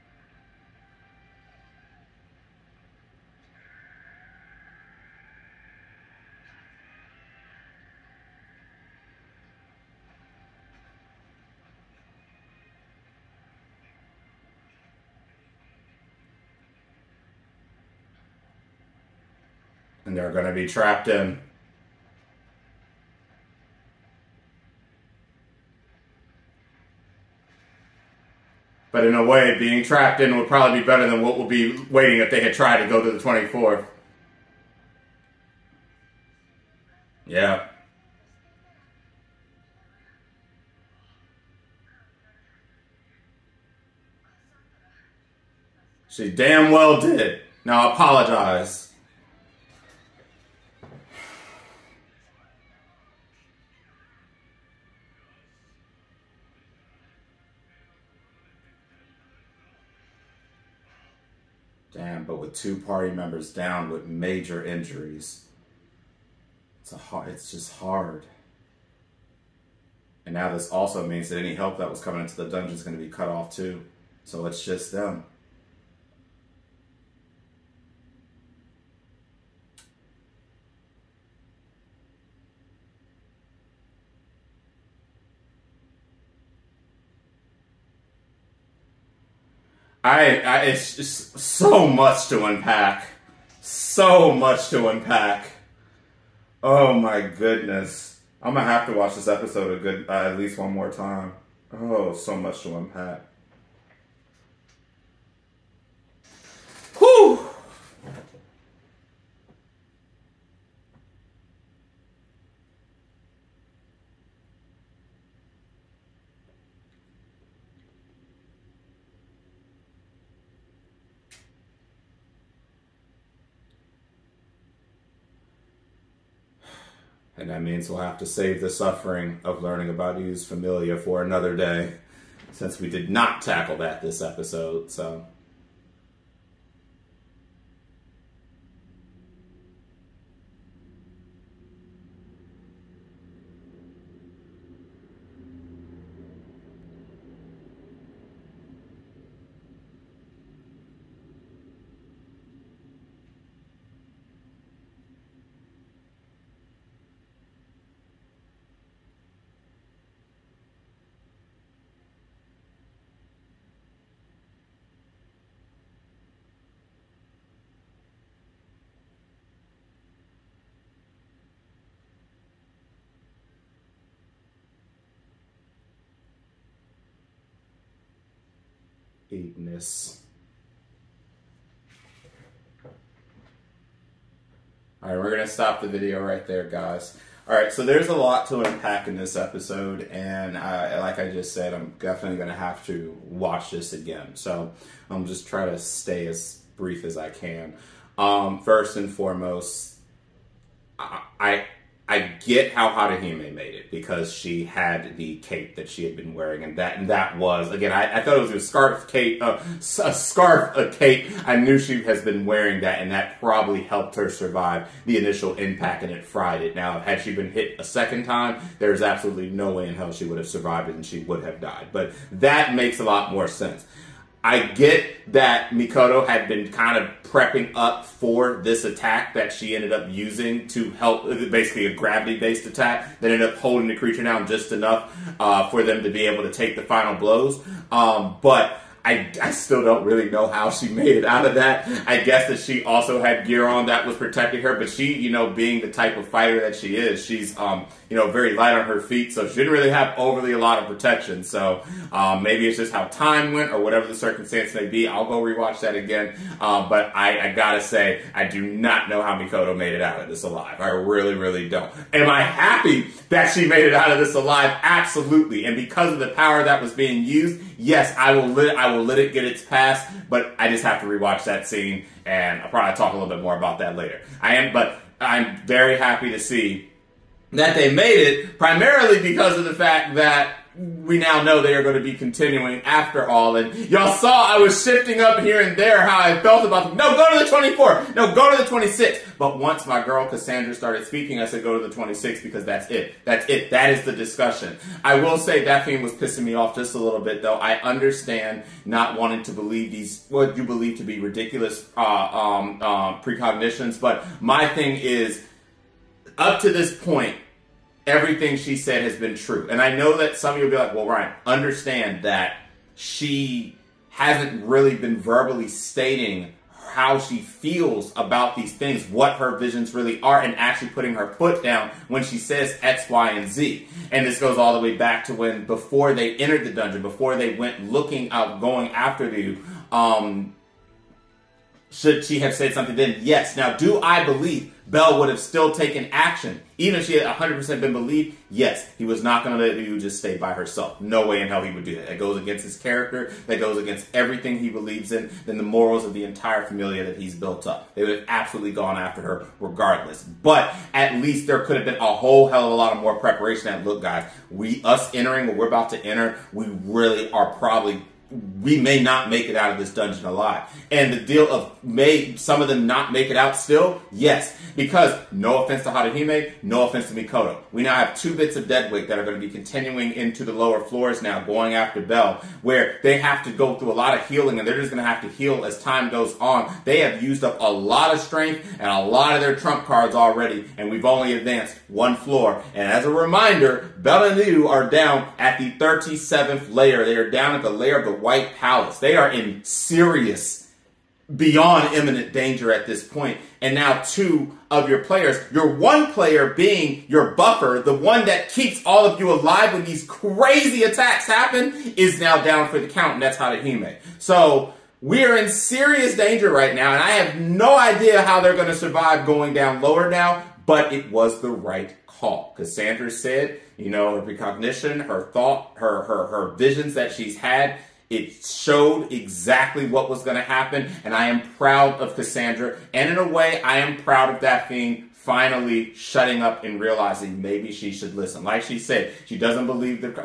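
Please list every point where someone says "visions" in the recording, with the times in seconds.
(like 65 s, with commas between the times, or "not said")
319 s, 416 s.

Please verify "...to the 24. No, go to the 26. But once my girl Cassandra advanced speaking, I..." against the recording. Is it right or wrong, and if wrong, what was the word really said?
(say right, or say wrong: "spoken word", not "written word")
wrong: "started", not "advanced".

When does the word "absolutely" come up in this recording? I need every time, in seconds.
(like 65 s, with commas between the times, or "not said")
219 s, 264 s, 348 s.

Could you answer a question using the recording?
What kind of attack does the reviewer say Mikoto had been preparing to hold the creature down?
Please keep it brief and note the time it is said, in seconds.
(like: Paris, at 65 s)
gravity based attack, at 231 s.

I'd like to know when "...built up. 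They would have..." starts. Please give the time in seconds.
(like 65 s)
347 s.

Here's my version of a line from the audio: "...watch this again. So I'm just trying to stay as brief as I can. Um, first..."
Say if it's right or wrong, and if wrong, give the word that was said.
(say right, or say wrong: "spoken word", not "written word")
right.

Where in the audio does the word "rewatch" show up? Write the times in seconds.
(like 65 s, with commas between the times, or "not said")
255 s, 271 s.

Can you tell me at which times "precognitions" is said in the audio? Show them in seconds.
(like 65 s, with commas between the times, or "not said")
303 s, 414 s.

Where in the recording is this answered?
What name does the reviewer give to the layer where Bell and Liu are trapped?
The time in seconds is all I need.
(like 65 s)
388 s.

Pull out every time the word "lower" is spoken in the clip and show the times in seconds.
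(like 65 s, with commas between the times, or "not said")
370 s, 409 s.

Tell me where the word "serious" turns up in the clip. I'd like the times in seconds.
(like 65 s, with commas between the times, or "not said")
389 s, 405 s.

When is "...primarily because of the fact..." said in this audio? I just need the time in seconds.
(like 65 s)
278 s.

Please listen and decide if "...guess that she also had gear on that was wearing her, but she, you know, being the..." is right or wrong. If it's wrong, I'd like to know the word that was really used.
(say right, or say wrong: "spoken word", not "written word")
wrong: "protecting", not "wearing".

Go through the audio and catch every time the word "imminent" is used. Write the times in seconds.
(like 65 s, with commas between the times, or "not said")
391 s.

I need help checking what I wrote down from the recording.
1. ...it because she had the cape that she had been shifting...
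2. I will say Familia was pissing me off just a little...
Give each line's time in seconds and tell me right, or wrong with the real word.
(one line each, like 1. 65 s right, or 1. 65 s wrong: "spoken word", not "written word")
1. 203 s wrong: "wearing", not "shifting"
2. 295 s wrong: "Daphne", not "Familia".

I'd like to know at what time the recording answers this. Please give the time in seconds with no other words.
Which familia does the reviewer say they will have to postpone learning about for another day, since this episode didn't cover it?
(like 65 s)
130 s.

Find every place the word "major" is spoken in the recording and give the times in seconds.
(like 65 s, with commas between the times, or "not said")
64 s.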